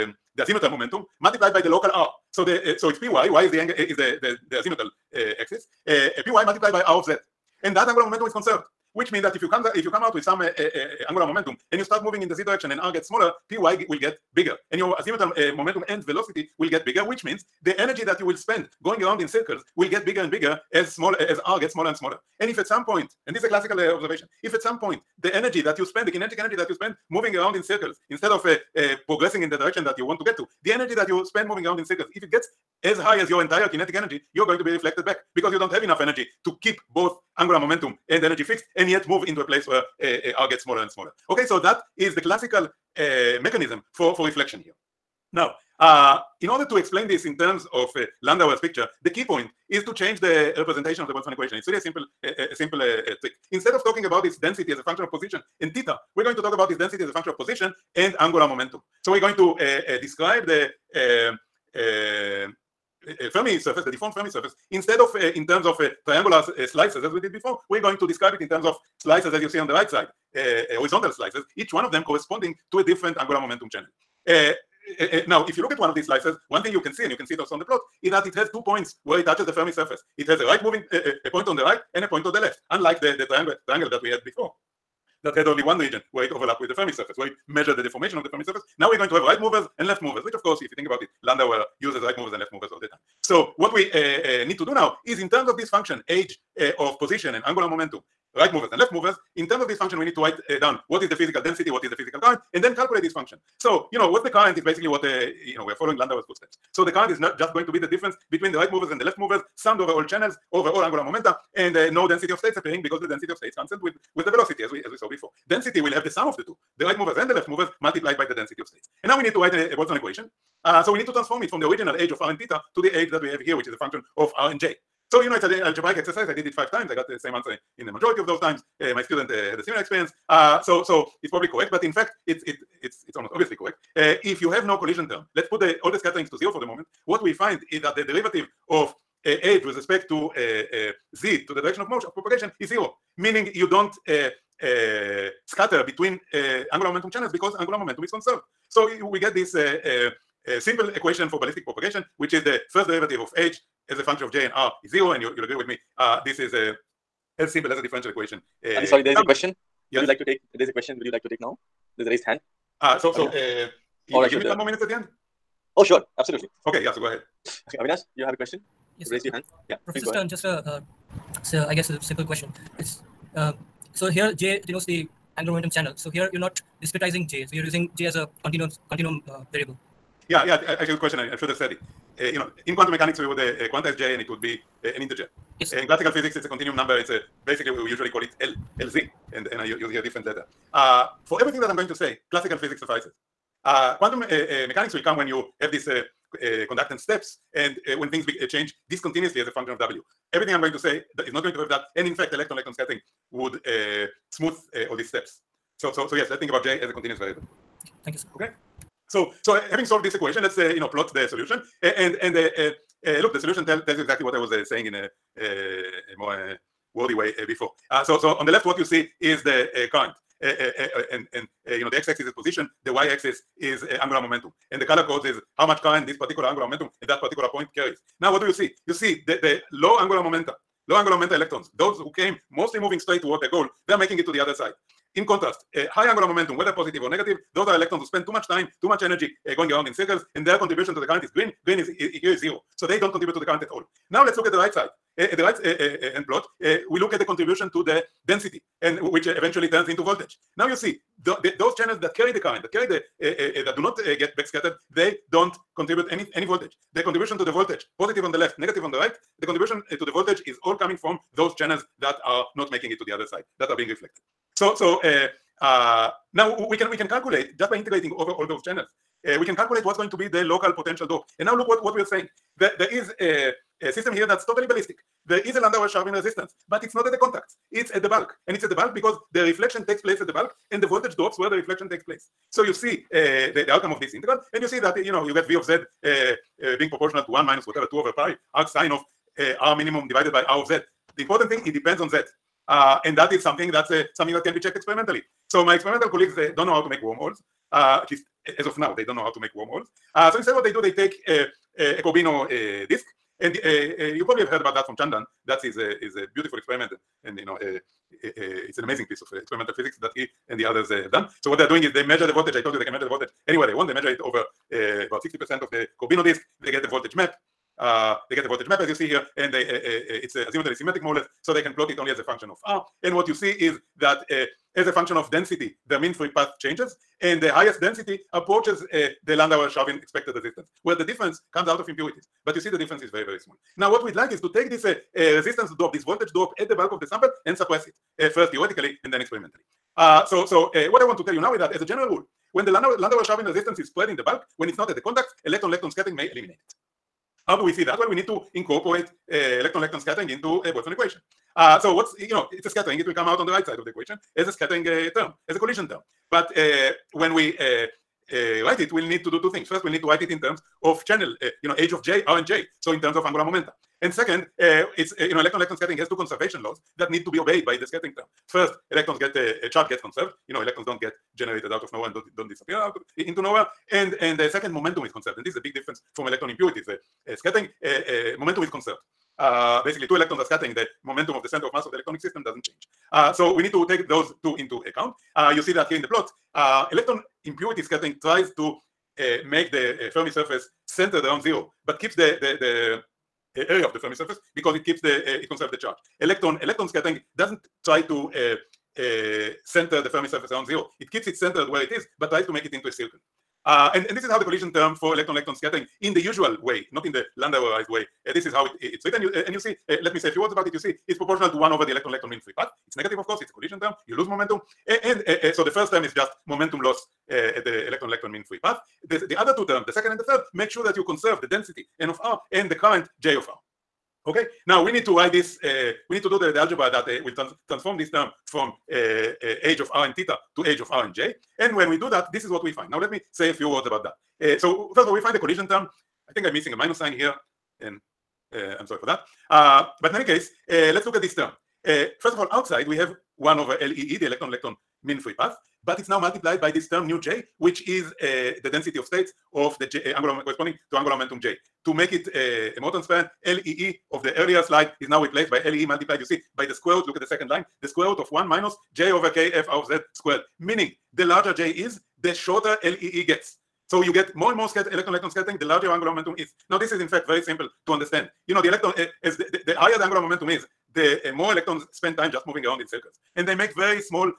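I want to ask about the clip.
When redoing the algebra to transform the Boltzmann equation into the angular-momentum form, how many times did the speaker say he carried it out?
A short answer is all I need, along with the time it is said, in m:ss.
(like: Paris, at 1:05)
5, at 2:06.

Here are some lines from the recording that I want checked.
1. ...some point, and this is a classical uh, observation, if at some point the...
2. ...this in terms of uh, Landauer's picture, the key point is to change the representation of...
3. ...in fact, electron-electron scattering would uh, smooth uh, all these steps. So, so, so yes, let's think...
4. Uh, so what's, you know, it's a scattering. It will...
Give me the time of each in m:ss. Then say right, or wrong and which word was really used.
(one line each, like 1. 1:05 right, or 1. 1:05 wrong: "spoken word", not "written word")
1. 0:22 right
2. 0:47 right
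3. 3:22 right
4. 5:51 right.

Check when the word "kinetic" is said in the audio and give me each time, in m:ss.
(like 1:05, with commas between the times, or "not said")
0:26, 0:33.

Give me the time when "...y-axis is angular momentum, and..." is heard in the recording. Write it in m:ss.
3:42.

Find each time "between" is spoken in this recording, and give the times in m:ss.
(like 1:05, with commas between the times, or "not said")
1:48, 2:25.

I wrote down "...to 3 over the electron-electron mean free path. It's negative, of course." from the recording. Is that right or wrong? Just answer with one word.
wrong.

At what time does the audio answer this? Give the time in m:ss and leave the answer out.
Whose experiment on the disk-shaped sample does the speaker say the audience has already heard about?
5:04.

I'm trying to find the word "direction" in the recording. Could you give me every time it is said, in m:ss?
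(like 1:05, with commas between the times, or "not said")
0:12, 0:29, 2:21.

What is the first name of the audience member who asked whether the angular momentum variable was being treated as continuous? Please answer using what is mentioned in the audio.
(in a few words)
Avinash.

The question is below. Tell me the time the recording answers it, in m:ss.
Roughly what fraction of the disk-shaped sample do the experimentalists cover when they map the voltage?
5:15.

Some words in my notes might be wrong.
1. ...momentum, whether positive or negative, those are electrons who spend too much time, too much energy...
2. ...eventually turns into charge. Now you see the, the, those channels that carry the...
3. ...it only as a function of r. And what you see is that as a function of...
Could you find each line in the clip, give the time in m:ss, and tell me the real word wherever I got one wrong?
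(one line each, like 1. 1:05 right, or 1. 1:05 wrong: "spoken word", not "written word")
1. 3:56 right
2. 4:09 wrong: "voltage", not "charge"
3. 5:21 right.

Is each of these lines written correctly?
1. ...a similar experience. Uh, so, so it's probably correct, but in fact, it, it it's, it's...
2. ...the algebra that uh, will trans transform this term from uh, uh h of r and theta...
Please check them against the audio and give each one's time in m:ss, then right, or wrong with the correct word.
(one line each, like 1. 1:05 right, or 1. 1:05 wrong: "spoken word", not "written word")
1. 2:09 right
2. 7:06 right.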